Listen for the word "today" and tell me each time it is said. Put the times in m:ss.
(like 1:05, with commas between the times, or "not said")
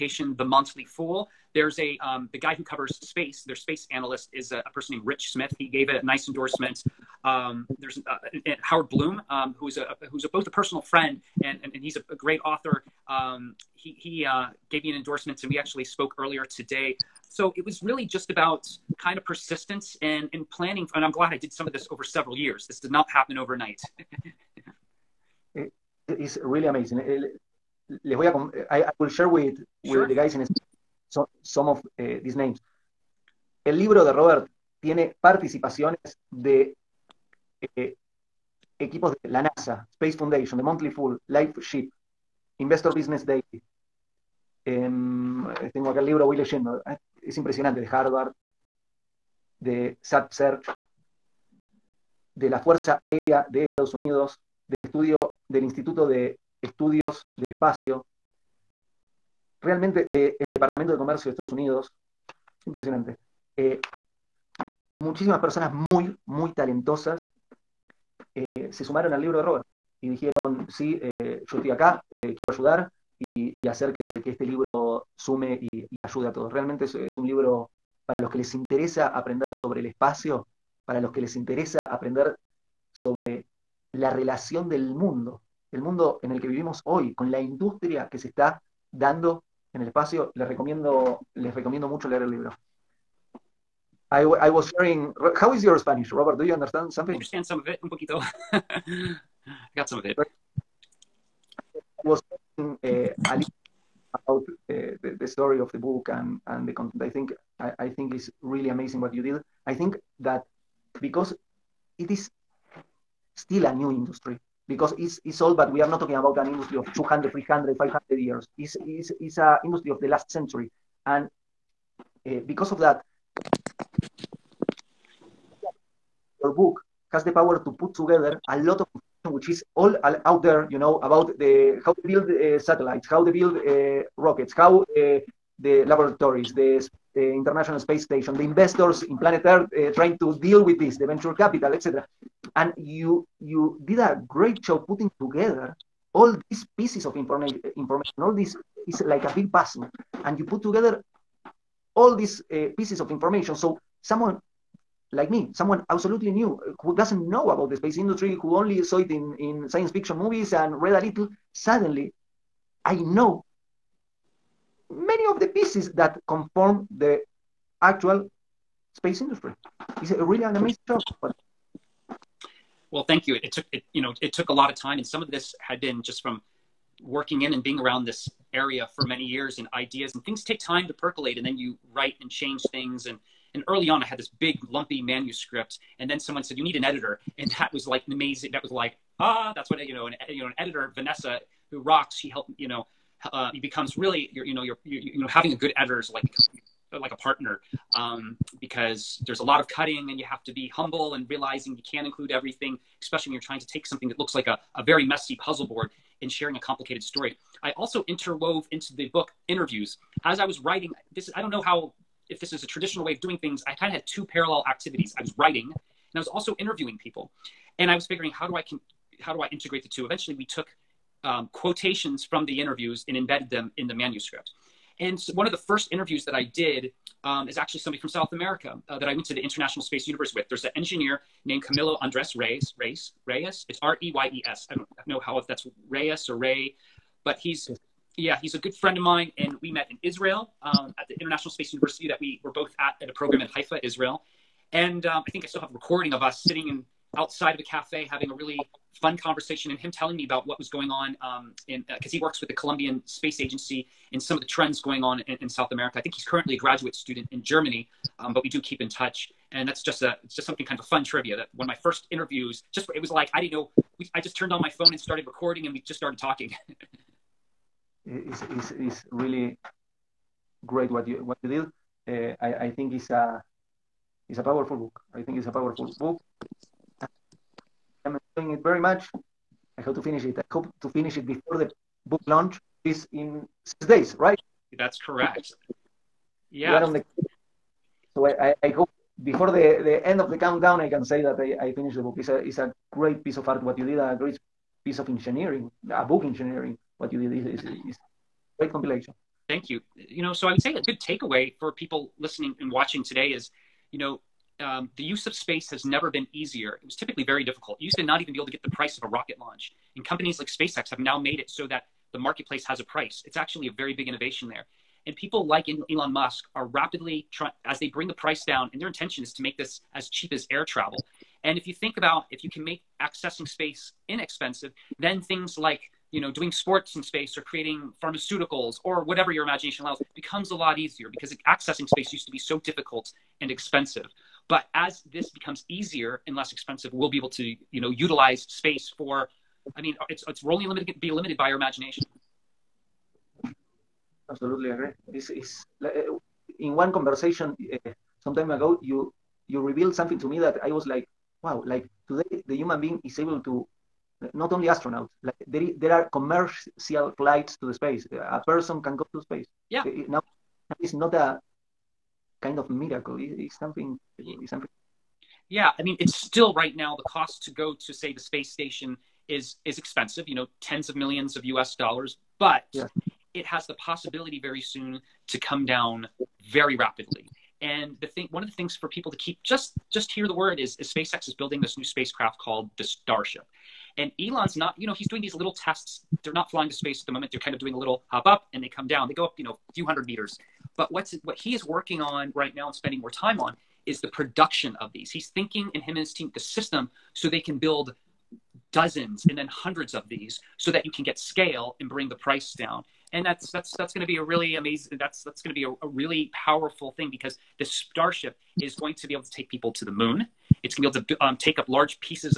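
0:16, 5:03, 5:52.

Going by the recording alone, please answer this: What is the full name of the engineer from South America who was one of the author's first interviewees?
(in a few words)
Camilo Andres Reyes.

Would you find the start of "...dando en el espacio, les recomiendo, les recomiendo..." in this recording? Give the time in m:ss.
1:28.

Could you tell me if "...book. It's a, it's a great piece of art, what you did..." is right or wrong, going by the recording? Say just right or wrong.
right.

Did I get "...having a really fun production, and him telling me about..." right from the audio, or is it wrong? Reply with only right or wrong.
wrong.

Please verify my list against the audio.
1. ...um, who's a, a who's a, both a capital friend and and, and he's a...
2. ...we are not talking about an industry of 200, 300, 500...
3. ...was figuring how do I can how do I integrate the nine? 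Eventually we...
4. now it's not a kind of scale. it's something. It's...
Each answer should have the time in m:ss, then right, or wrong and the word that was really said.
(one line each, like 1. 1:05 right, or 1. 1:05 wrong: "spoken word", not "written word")
1. 0:09 wrong: "personal", not "capital"
2. 1:55 right
3. 3:37 wrong: "two", not "nine"
4. 6:00 wrong: "miracle", not "scale".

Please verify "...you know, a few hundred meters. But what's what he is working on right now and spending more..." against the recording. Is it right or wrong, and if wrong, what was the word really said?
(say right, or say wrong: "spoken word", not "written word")
right.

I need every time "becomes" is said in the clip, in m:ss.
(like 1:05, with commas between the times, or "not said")
3:13, 5:30, 5:35.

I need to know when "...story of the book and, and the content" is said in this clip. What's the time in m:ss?
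1:45.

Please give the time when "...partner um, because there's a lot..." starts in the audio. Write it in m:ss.
3:17.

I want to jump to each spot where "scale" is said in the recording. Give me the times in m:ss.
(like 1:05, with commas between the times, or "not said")
6:41.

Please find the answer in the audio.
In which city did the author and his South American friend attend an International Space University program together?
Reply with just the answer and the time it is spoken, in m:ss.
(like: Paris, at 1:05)
Haifa, at 4:03.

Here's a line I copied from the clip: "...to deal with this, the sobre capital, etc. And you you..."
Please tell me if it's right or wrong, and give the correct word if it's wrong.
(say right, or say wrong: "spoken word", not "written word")
wrong: "venture", not "sobre".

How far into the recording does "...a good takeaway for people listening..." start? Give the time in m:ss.
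5:00.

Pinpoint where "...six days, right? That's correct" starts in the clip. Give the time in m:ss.
4:43.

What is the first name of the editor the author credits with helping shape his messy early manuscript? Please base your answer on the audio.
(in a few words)
Vanessa.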